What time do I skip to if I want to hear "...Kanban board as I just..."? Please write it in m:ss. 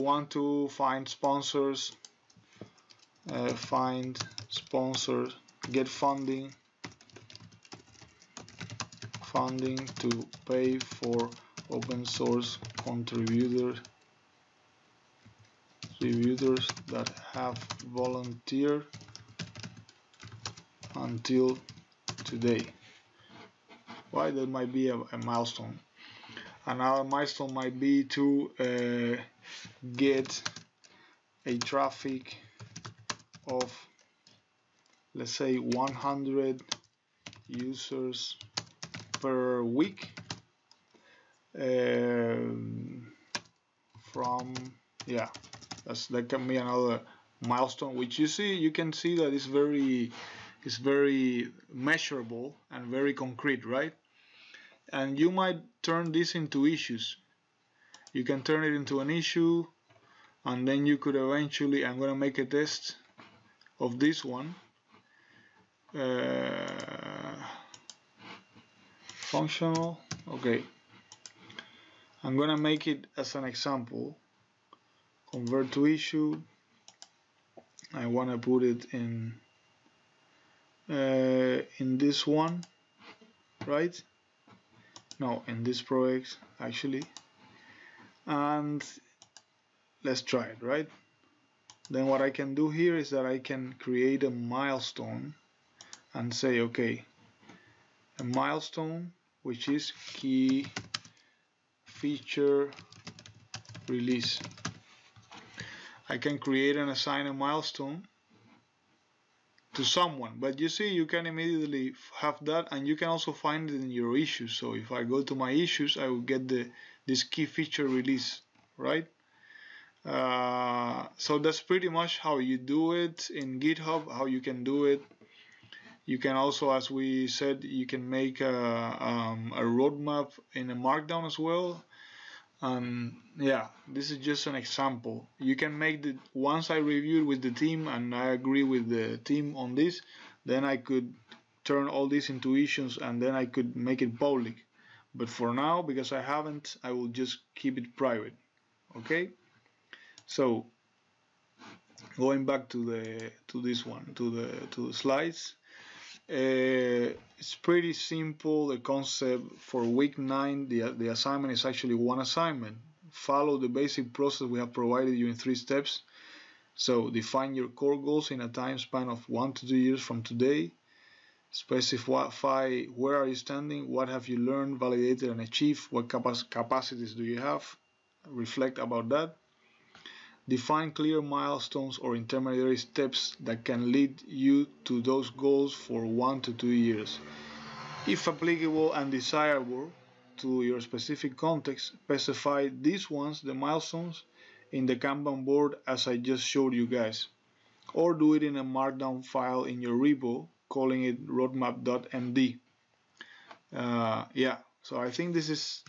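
3:14.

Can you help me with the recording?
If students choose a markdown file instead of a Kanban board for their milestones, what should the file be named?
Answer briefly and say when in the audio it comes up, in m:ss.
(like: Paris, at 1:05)
roadmap.md, at 3:21.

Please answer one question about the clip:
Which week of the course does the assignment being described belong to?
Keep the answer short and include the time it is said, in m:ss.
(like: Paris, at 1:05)
Week 9, at 2:39.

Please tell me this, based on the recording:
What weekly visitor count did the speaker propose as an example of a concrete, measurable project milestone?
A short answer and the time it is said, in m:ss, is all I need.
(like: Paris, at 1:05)
100 users per week, at 0:35.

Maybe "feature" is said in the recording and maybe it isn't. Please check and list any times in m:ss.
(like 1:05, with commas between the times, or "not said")
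1:41, 1:57.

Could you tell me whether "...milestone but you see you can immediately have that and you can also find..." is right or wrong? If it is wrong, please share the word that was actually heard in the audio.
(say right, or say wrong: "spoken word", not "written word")
wrong: "someone", not "milestone".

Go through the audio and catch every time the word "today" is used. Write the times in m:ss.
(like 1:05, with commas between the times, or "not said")
0:22, 2:50.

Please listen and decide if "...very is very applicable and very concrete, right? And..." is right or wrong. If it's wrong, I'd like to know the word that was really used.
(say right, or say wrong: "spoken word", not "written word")
wrong: "measurable", not "applicable".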